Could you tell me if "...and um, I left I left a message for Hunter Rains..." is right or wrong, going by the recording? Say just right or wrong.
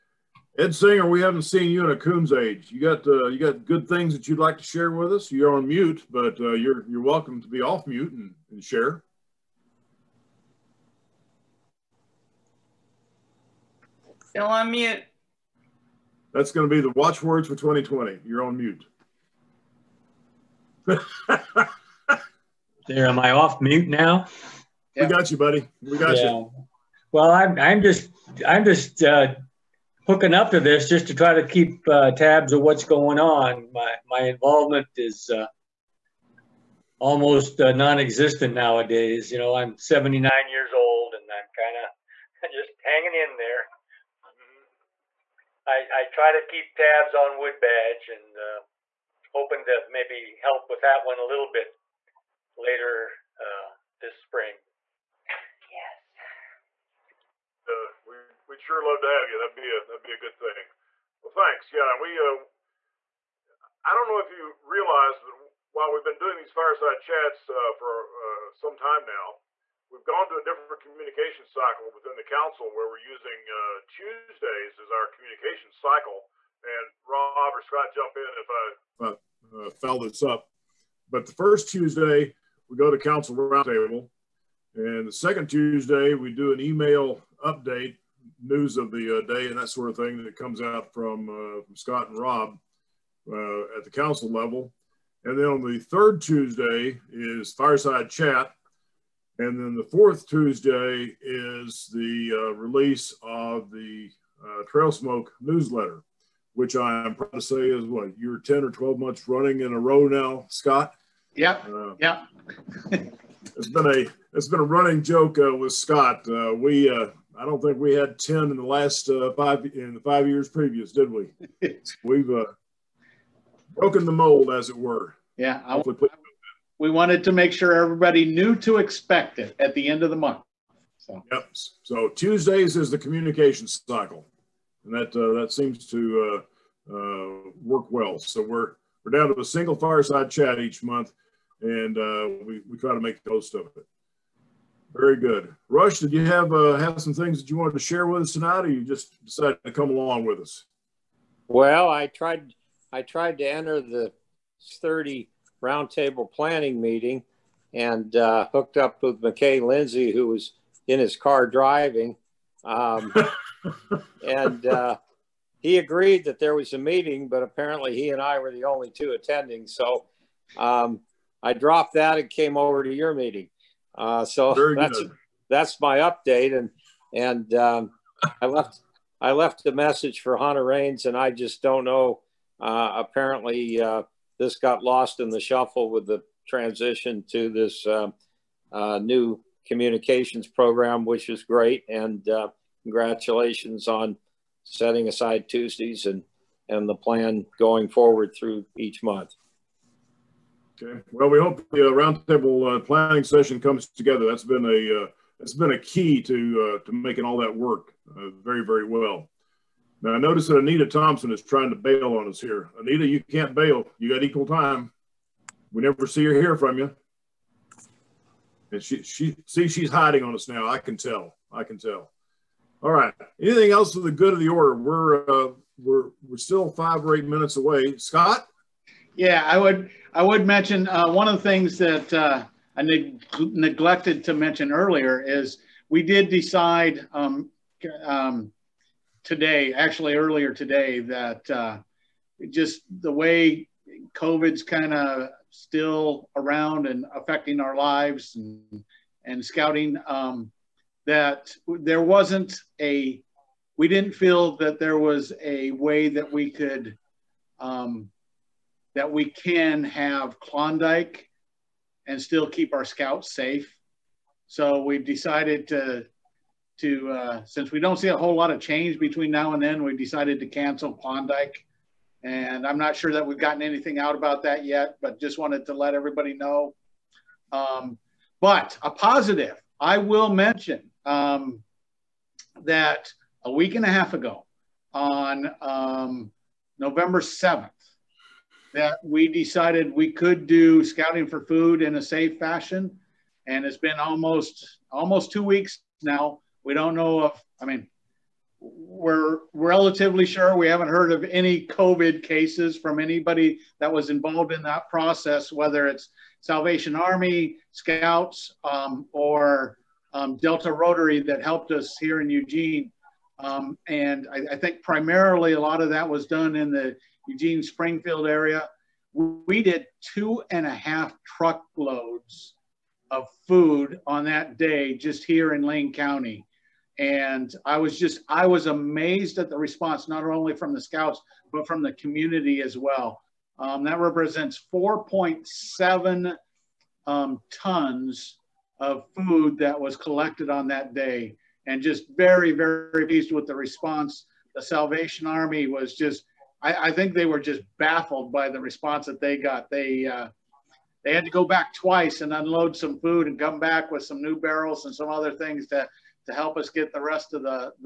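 right.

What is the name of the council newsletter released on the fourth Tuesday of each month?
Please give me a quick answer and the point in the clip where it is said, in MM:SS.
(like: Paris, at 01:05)
Trail Smoke, at 01:44.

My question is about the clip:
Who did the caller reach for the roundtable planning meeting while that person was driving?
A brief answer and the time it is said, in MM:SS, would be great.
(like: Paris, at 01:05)
McKay Lindsay, at 02:39.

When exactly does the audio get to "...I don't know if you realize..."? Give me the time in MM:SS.
01:03.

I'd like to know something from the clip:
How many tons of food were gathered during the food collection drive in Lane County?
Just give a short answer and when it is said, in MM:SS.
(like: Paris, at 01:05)
4.7 tons, at 05:34.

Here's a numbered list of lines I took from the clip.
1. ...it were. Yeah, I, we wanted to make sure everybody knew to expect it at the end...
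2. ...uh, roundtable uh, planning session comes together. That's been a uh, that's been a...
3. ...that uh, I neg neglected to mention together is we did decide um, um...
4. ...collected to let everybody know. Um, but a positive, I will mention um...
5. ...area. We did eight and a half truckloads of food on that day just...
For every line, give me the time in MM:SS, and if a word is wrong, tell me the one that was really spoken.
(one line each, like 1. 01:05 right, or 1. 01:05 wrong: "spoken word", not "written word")
1. 02:04 right
2. 03:21 right
3. 03:51 wrong: "earlier", not "together"
4. 04:35 wrong: "wanted", not "collected"
5. 05:18 wrong: "two", not "eight".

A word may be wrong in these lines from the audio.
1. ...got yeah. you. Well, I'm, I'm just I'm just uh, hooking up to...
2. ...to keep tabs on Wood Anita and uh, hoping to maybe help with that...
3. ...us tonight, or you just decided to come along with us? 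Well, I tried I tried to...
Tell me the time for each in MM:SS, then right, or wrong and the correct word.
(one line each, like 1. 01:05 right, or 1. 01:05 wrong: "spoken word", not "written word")
1. 00:25 right
2. 00:46 wrong: "Badge", not "Anita"
3. 02:28 right.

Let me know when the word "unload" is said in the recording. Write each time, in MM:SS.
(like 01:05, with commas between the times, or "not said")
05:52.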